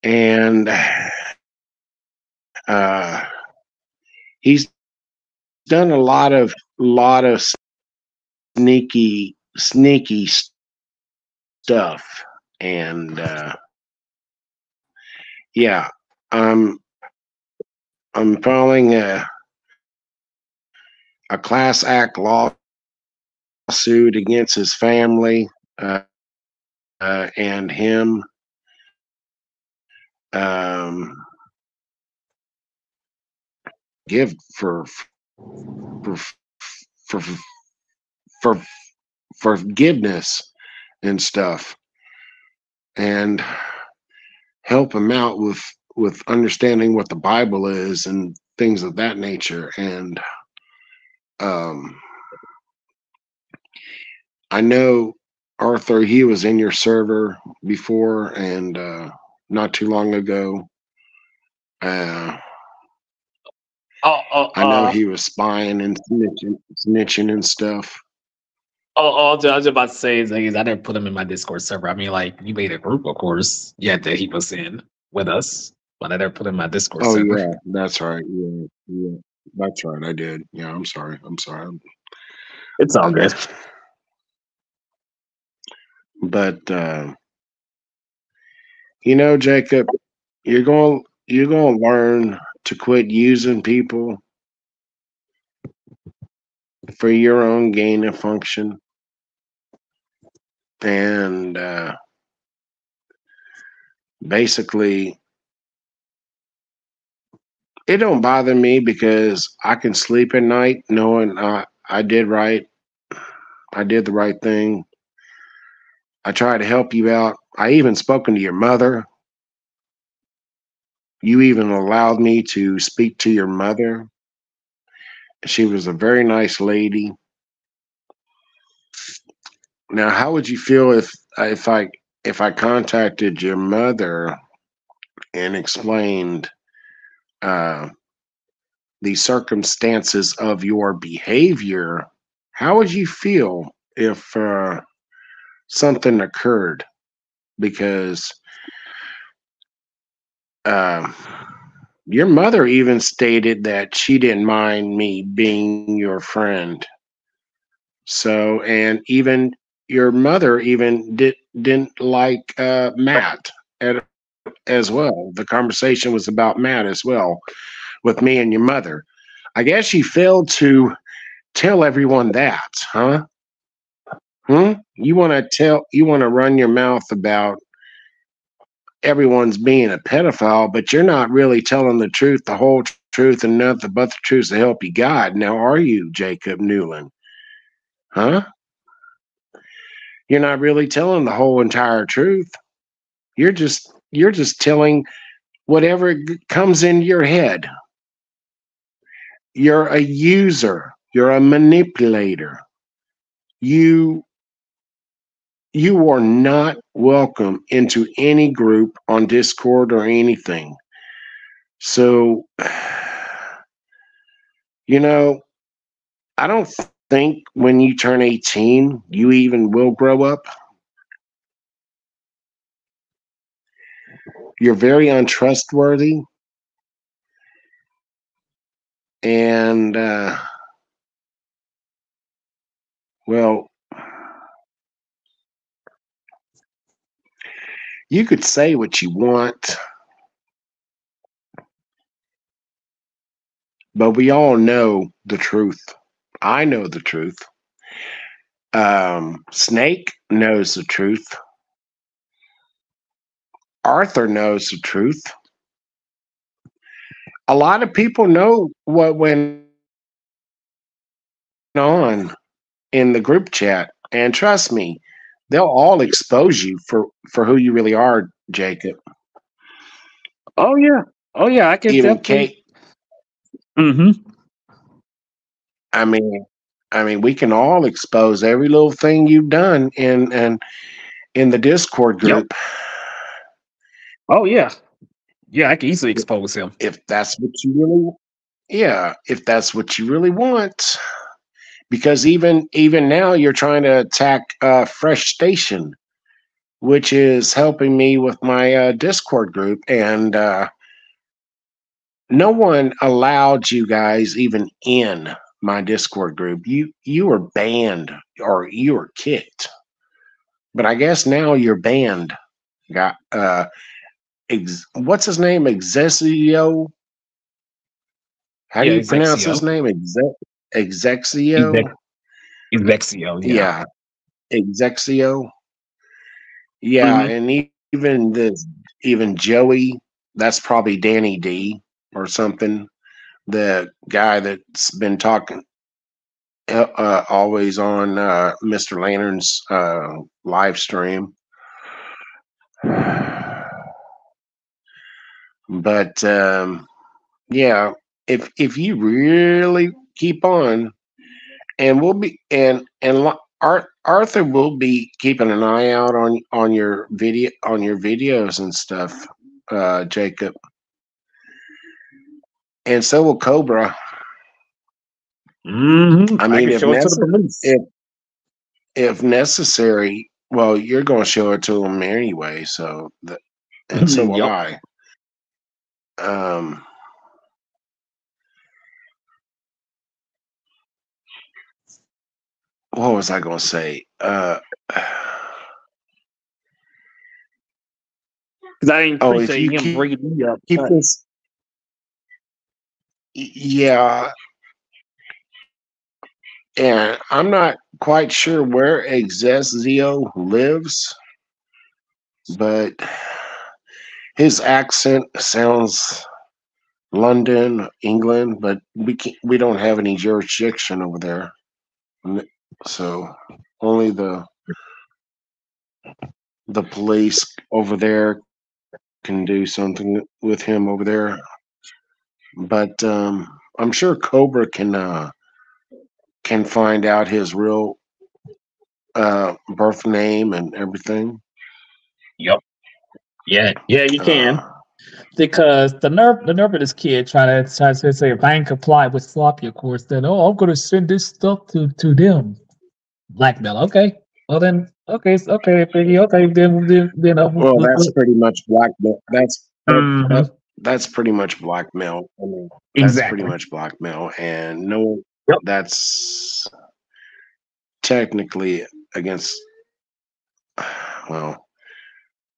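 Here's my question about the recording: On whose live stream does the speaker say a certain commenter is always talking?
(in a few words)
Mr. Lantern.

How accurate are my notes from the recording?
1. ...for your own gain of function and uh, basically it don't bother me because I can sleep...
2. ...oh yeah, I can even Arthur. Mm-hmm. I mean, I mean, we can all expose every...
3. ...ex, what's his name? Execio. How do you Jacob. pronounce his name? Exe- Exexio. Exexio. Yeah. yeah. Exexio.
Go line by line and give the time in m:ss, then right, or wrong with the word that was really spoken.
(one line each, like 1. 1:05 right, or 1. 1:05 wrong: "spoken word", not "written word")
1. 1:36 right
2. 4:31 wrong: "Kate", not "Arthur"
3. 5:14 wrong: "Exexio", not "Jacob".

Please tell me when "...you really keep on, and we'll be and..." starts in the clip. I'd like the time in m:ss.
5:48.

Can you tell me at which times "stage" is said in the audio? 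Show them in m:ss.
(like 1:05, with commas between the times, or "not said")
not said.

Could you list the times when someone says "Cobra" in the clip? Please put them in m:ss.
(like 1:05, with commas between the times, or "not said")
6:03, 7:04.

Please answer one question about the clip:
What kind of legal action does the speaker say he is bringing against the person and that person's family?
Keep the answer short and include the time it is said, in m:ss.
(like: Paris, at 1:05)
class act lawsuit, at 0:21.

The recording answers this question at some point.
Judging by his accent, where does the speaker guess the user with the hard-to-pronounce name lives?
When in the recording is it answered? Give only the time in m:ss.
6:47.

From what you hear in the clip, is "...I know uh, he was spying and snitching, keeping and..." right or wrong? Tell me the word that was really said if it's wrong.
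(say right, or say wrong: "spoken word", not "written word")
wrong: "snitching", not "keeping".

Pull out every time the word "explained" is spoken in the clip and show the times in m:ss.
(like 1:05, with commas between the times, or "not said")
2:15.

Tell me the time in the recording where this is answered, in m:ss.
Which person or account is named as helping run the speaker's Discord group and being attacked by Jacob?
4:54.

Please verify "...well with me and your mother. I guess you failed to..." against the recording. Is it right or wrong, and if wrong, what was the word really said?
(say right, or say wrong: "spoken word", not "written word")
right.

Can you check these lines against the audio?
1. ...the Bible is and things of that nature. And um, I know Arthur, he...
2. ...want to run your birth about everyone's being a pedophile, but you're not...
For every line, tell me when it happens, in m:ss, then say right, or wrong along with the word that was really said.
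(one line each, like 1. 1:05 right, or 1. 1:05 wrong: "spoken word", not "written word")
1. 0:47 right
2. 2:56 wrong: "mouth", not "birth".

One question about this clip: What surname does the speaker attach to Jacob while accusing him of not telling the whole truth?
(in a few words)
Newland.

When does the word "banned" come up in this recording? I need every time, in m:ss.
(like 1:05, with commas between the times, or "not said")
5:07, 5:11.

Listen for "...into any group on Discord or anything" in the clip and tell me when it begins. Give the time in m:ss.
3:27.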